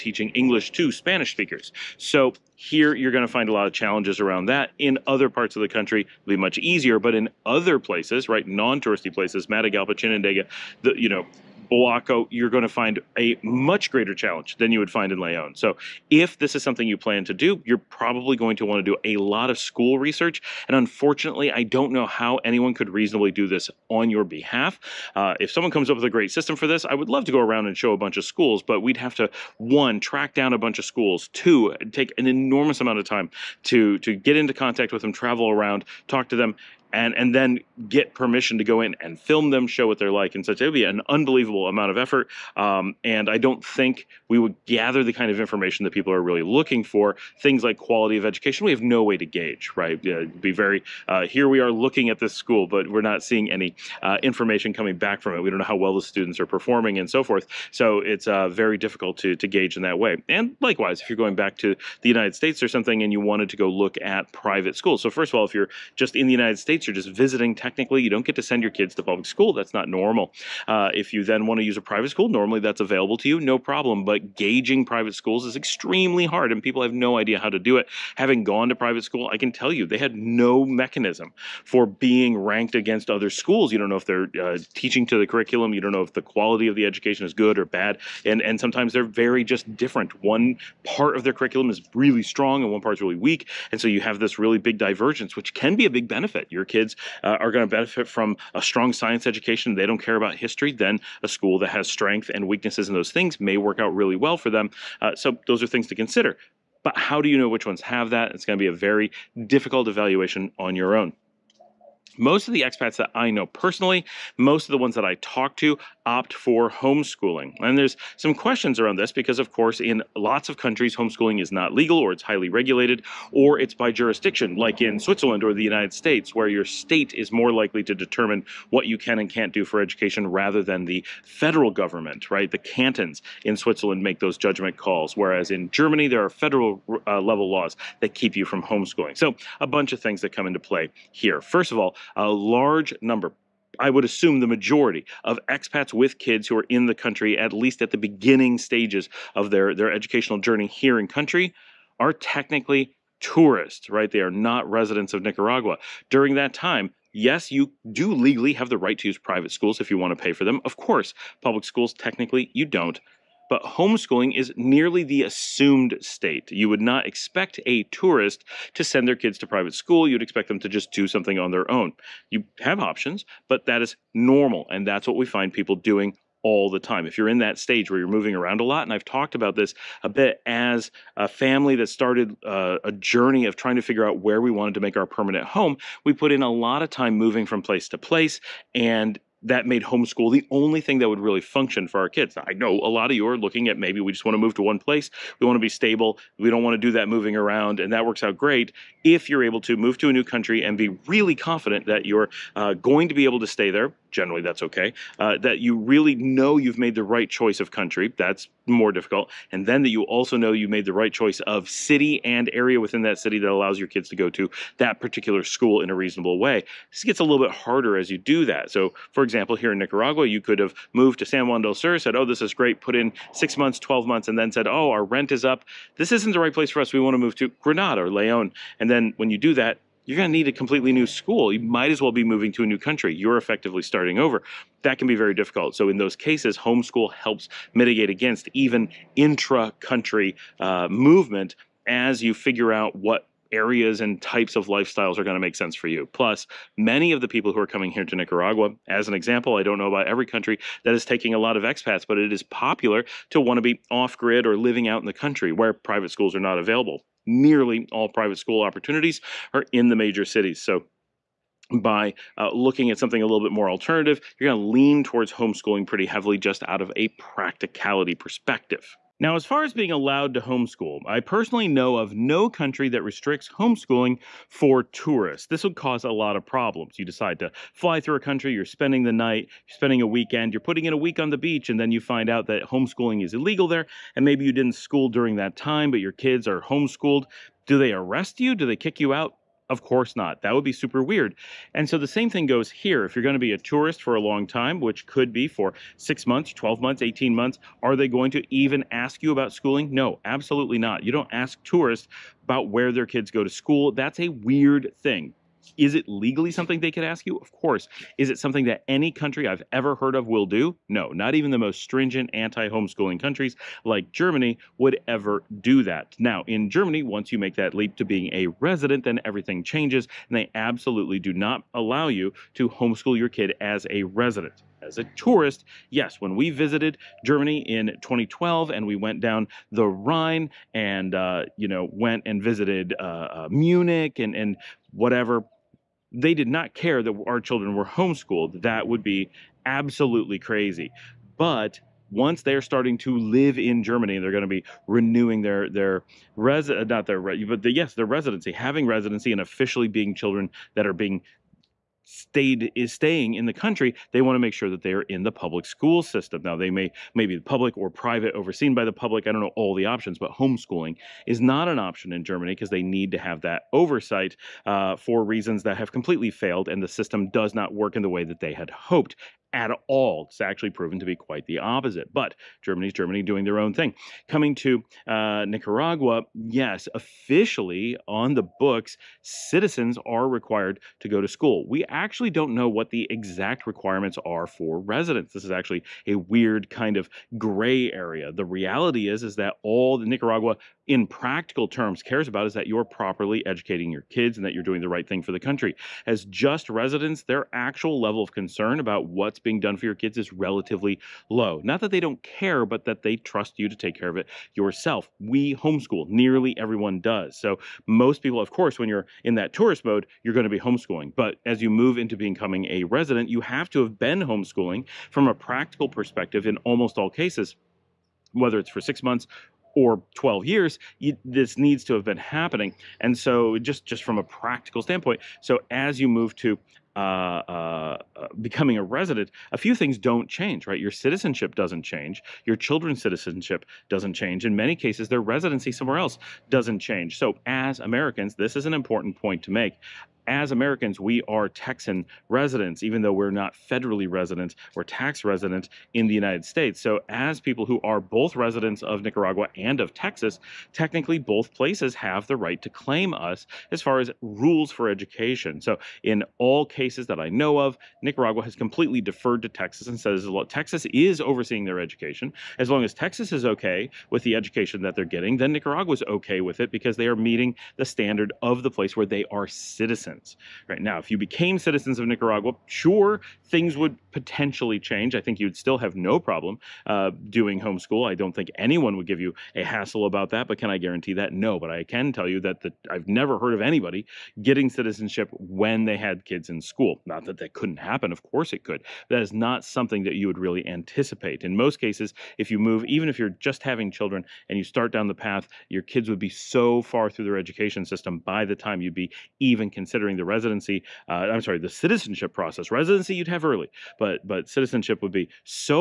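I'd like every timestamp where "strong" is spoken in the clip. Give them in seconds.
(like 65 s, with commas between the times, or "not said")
92 s, 98 s.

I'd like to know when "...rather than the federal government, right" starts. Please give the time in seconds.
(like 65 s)
130 s.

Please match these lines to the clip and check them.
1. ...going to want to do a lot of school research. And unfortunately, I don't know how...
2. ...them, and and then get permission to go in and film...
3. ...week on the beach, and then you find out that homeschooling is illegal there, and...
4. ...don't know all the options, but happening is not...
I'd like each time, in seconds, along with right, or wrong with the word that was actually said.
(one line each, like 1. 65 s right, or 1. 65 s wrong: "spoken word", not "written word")
1. 18 s right
2. 36 s right
3. 280 s right
4. 359 s wrong: "homeschooling", not "happening".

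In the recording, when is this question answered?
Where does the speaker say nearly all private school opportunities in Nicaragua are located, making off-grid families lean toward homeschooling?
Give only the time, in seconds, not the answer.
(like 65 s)
259 s.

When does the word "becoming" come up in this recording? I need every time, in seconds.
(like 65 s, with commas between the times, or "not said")
412 s, 428 s.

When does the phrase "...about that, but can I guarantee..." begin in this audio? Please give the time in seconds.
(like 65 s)
480 s.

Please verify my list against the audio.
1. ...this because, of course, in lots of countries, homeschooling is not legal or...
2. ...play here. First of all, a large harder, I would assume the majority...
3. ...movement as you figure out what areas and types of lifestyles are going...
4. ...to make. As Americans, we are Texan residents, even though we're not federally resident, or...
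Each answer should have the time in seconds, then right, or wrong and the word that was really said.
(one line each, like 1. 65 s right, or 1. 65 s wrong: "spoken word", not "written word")
1. 118 s right
2. 140 s wrong: "number", not "harder"
3. 240 s right
4. 439 s right.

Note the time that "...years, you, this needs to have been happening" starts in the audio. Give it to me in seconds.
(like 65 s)
420 s.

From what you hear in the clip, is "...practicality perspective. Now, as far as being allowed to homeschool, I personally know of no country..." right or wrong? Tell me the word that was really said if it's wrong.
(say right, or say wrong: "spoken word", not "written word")
right.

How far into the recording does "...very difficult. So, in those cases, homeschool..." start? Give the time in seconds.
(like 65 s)
235 s.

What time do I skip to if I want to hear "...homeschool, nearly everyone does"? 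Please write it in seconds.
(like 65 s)
405 s.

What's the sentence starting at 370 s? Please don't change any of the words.
It's actually proven to be quite the opposite.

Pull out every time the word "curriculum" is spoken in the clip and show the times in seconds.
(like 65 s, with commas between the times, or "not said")
85 s, 91 s.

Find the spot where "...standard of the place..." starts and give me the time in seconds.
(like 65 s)
467 s.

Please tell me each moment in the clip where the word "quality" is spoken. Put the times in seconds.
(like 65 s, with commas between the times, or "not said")
47 s, 86 s.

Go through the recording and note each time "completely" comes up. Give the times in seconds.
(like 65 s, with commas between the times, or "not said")
230 s, 365 s, 458 s.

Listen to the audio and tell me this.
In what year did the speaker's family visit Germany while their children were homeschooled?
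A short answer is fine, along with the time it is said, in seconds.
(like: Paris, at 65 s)
2012, at 328 s.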